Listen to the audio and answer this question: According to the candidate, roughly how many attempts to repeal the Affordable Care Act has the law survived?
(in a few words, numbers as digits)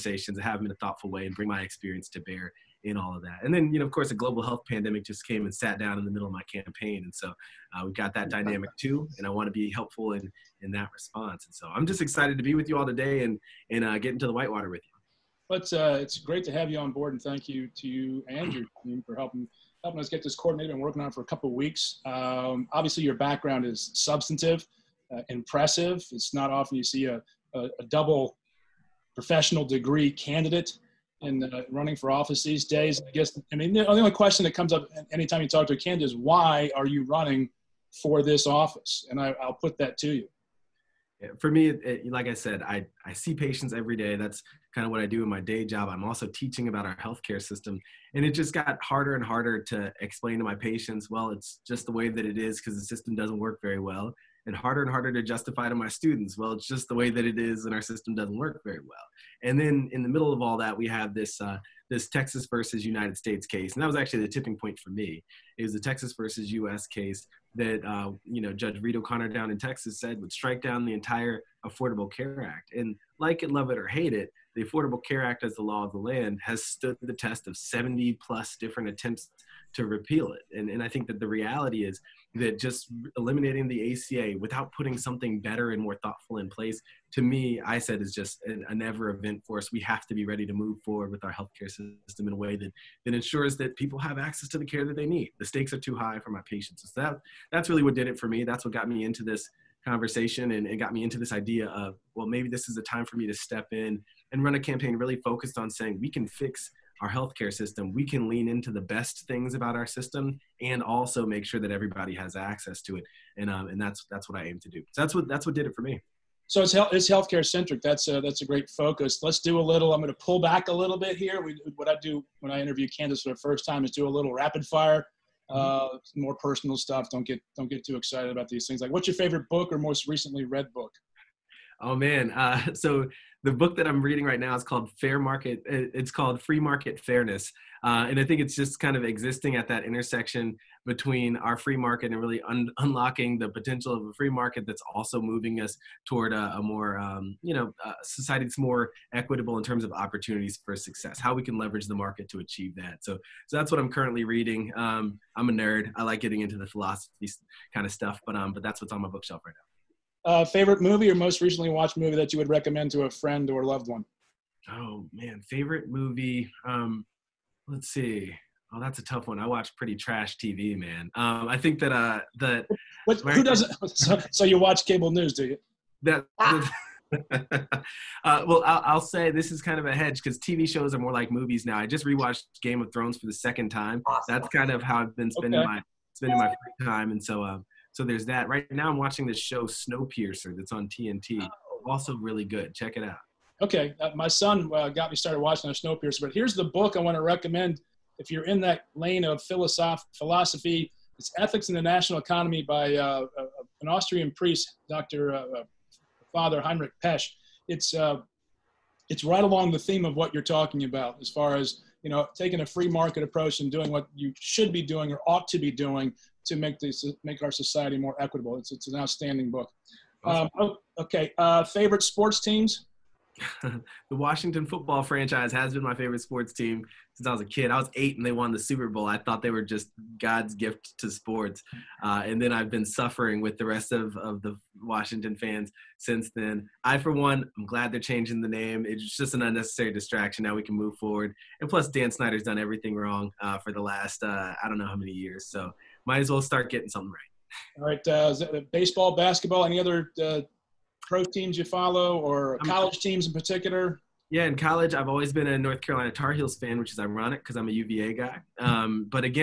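70 plus.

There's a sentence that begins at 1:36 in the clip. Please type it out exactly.
So that, that's really what did it for me.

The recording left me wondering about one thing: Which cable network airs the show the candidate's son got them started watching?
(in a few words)
TNT.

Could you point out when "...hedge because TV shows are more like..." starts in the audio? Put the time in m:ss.
2:59.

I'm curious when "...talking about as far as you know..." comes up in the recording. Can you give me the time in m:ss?
3:30.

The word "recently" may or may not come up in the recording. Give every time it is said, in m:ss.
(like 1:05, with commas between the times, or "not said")
2:10, 2:41.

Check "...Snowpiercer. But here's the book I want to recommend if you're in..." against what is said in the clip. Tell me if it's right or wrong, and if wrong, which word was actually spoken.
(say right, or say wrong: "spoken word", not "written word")
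right.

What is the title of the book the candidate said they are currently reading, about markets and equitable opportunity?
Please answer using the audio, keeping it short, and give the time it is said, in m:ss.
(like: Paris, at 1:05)
Free Market Fairness, at 2:16.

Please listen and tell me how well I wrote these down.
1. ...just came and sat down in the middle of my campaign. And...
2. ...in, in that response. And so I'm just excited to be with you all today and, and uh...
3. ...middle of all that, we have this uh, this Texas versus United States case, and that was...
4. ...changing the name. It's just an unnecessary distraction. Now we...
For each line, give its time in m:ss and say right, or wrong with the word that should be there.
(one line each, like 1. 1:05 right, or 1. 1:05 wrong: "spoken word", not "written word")
1. 0:05 right
2. 0:10 right
3. 1:00 right
4. 3:57 right.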